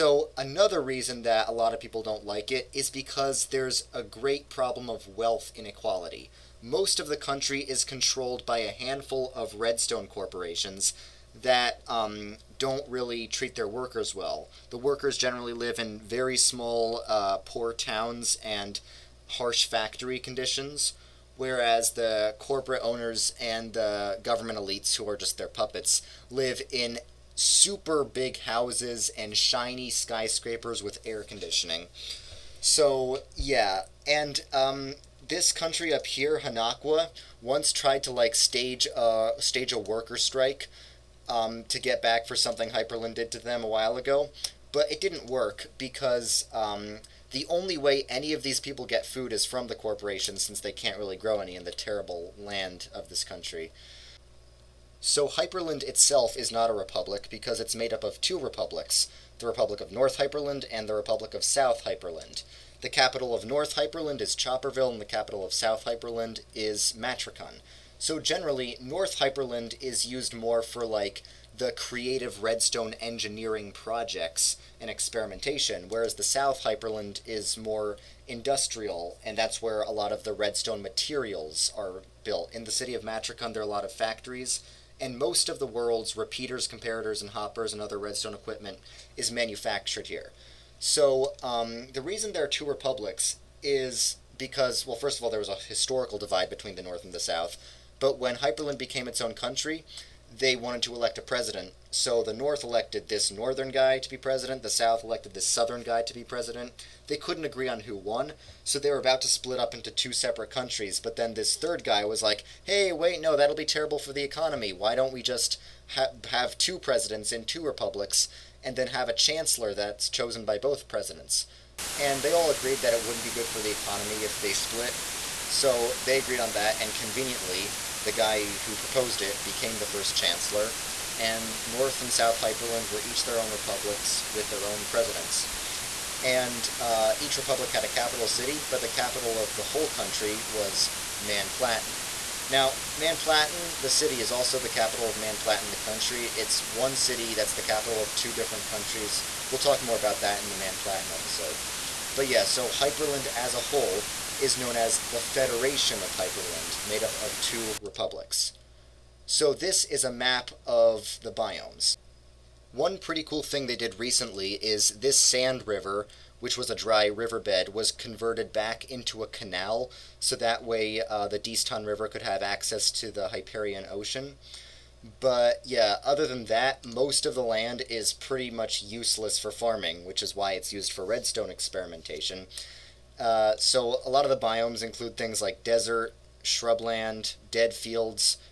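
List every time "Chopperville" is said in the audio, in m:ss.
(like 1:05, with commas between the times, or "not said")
1:04.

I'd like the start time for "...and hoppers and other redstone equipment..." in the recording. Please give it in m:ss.
1:27.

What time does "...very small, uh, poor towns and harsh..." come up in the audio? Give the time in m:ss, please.
0:16.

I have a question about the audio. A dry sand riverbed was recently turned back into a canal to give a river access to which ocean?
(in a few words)
Hyperion Ocean.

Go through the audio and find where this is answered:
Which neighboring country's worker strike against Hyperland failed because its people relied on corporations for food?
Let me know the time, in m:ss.
0:36.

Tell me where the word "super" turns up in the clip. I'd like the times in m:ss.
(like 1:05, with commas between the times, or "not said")
0:27.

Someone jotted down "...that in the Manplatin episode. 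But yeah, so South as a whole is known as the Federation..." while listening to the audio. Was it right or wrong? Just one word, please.
wrong.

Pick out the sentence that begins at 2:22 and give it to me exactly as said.
Now, Manplatin, the city, is also the capital of Manplatin, the country.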